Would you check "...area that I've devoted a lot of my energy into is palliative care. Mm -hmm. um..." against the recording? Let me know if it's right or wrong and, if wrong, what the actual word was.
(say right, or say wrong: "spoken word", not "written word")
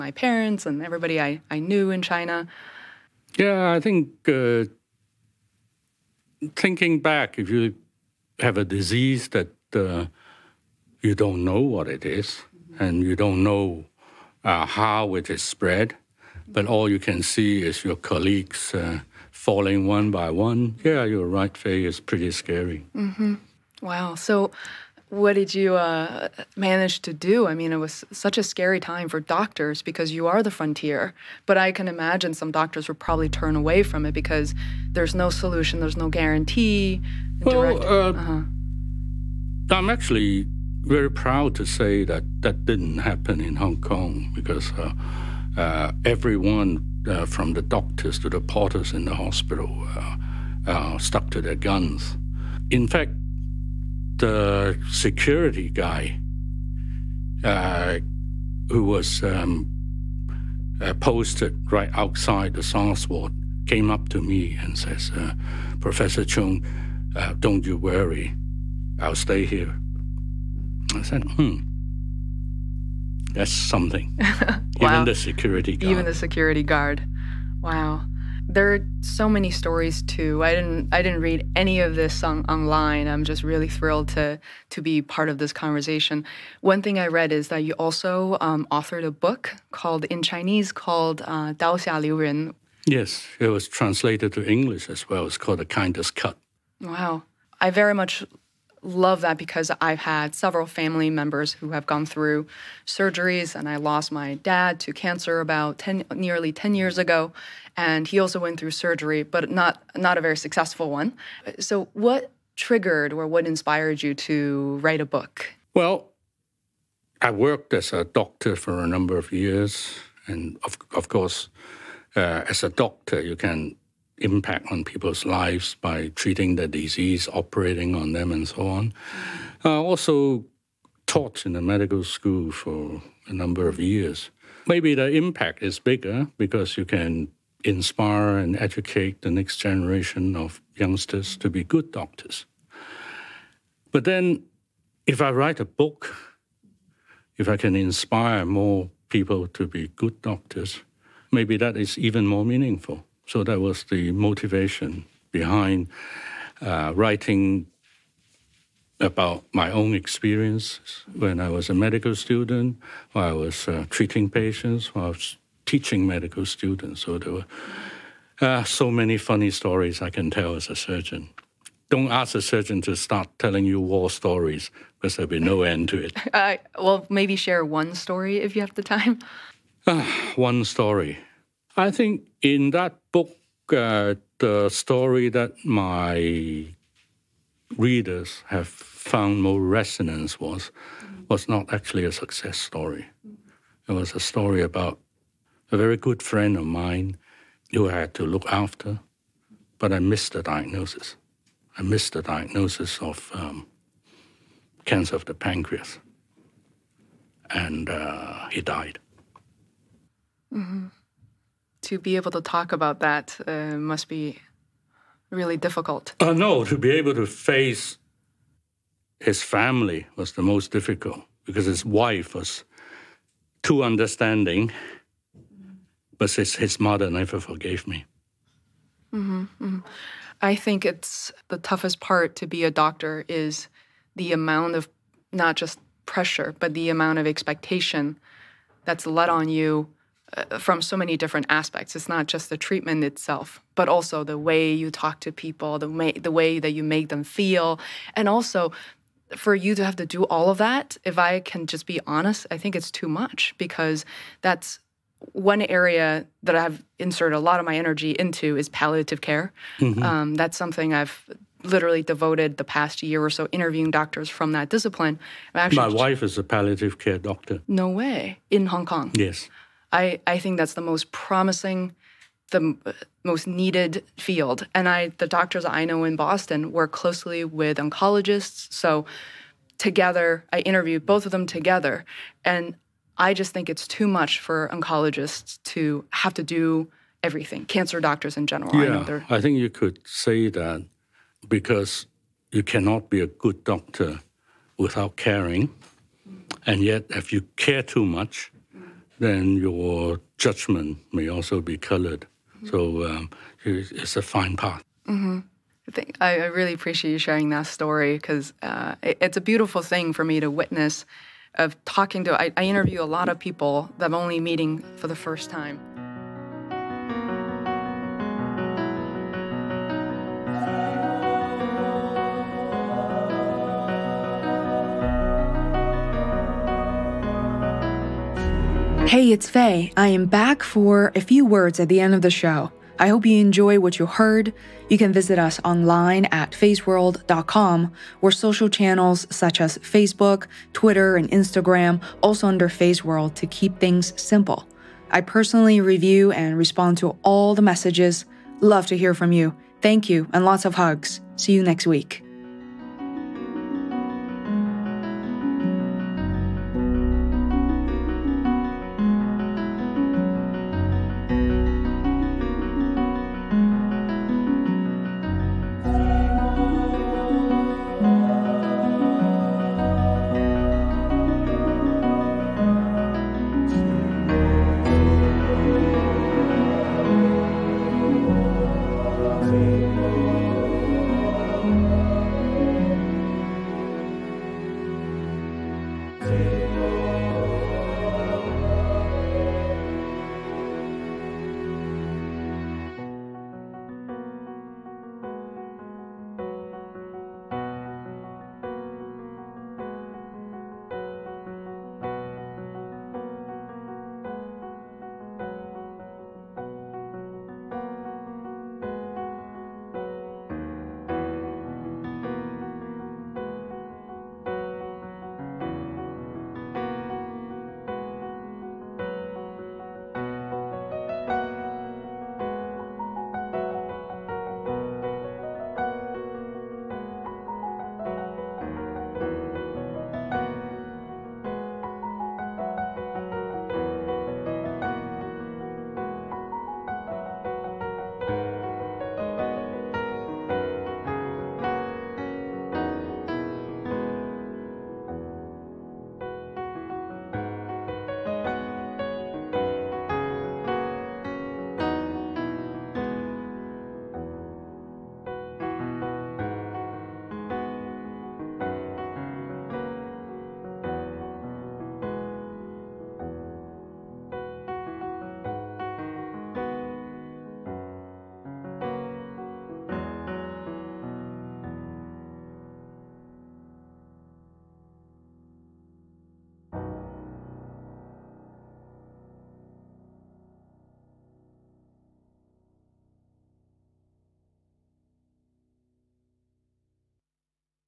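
wrong: "inserted", not "devoted".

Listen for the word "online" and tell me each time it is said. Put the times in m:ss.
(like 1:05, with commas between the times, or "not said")
1:22, 5:35.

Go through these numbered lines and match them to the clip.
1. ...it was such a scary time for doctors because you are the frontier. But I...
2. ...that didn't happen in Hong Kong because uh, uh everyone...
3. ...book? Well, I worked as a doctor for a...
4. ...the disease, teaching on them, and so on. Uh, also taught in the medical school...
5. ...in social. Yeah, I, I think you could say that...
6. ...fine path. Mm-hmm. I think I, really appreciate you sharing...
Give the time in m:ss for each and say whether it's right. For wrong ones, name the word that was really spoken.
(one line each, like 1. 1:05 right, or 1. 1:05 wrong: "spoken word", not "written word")
1. 0:27 right
2. 0:42 right
3. 1:55 right
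4. 2:06 wrong: "operating", not "teaching"
5. 4:48 wrong: "general", not "social"
6. 5:04 right.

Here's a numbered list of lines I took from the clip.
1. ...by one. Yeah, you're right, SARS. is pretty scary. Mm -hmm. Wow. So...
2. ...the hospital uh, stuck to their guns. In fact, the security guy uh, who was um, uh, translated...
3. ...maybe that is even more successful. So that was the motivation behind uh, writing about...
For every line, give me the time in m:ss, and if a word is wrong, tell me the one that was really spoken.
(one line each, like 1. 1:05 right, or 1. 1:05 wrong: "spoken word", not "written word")
1. 0:20 wrong: "Fei", not "SARS"
2. 0:49 wrong: "posted", not "translated"
3. 2:31 wrong: "meaningful", not "successful".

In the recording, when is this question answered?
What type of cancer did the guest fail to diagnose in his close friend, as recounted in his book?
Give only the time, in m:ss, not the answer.
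3:24.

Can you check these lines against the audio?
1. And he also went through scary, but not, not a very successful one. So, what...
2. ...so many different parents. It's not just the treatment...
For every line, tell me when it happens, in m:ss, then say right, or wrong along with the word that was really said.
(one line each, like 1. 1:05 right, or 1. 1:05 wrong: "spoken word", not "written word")
1. 1:47 wrong: "surgery", not "scary"
2. 4:00 wrong: "aspects", not "parents".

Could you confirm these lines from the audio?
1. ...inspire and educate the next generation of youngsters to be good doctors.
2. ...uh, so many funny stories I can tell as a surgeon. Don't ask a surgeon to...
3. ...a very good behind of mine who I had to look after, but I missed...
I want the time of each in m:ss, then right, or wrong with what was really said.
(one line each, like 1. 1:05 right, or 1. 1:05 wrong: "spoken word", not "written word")
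1. 2:17 right
2. 2:48 right
3. 3:15 wrong: "friend", not "behind".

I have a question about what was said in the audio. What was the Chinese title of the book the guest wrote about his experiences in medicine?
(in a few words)
Dao Xia Liu Ren.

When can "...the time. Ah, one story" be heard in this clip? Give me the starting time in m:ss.
2:58.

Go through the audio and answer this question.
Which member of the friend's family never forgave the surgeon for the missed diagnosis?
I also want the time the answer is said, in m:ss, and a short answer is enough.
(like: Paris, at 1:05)
his mother, at 3:46.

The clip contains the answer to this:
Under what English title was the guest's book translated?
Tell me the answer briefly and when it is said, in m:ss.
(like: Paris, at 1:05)
The Kindest Cut, at 1:35.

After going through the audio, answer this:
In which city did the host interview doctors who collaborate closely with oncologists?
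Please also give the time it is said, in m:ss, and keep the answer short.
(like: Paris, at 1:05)
Boston, at 4:36.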